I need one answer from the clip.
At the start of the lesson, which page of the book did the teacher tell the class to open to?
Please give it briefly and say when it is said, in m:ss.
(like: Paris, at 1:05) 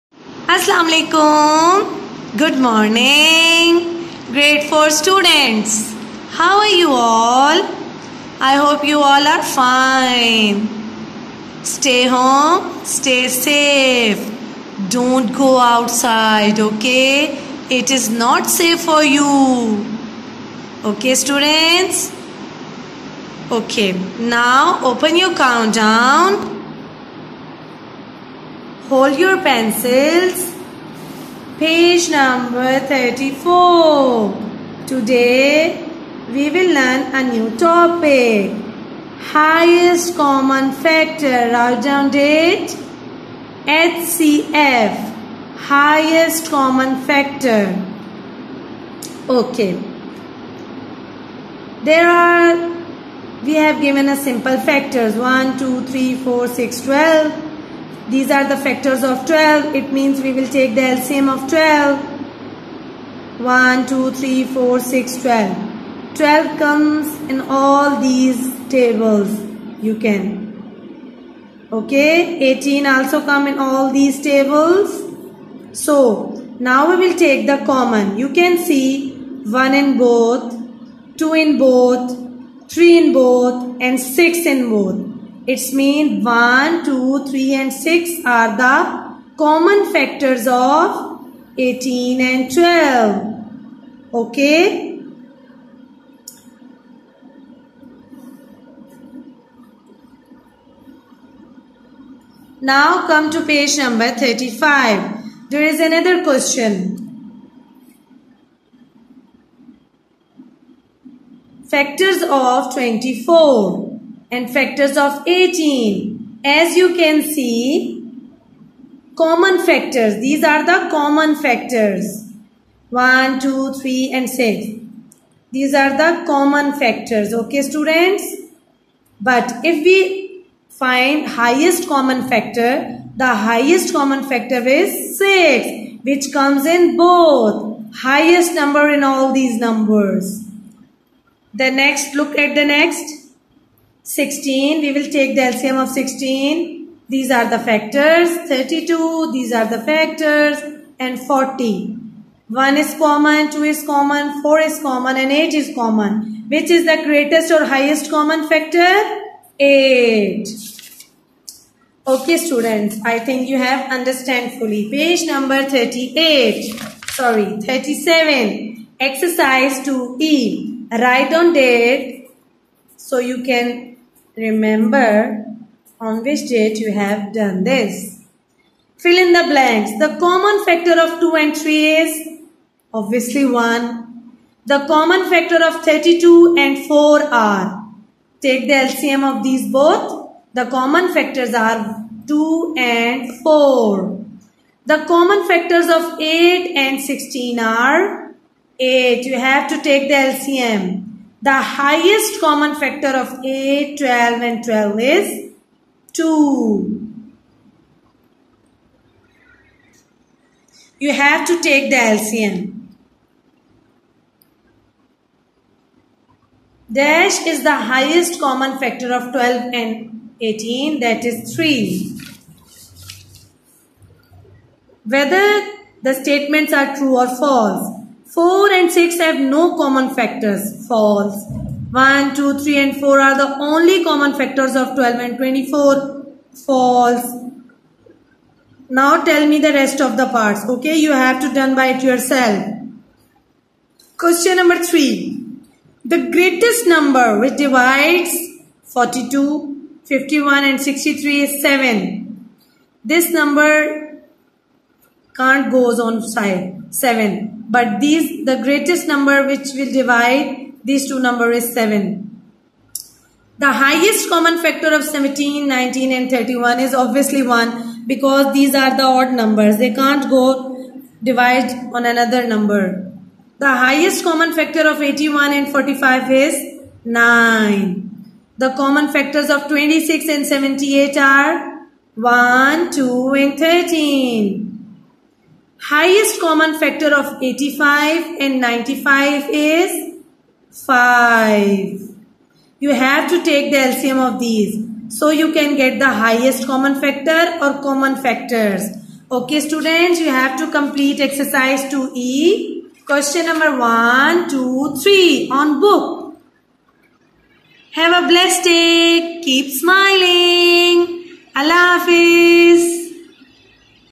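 34, at 0:31.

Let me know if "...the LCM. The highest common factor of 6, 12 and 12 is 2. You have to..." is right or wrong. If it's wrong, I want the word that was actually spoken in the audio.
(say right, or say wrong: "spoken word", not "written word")
wrong: "8", not "6".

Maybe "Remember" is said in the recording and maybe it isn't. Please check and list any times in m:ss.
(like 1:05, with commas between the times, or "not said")
2:54.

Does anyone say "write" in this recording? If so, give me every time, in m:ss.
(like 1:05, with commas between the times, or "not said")
0:41, 2:50.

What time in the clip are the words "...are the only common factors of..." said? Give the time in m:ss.
3:53.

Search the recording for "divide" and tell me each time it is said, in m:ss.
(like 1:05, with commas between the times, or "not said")
4:07, 4:19, 4:31.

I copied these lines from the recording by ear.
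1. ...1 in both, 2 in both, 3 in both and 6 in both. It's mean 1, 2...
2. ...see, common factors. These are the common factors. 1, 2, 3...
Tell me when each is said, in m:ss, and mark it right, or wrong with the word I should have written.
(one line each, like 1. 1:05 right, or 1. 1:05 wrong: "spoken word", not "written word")
1. 1:19 right
2. 1:57 right.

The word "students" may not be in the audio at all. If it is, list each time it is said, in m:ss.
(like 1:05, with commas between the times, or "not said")
0:04, 0:21, 2:07, 2:42, 4:59.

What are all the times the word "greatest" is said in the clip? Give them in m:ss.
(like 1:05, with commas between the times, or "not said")
2:37, 4:06, 4:18.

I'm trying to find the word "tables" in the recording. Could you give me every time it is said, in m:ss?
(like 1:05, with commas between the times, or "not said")
1:08, 1:14.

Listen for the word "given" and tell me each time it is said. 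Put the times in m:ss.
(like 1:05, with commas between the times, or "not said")
0:53.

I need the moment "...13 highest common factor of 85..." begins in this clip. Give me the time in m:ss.
4:43.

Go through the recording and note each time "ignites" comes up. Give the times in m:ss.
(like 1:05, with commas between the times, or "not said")
not said.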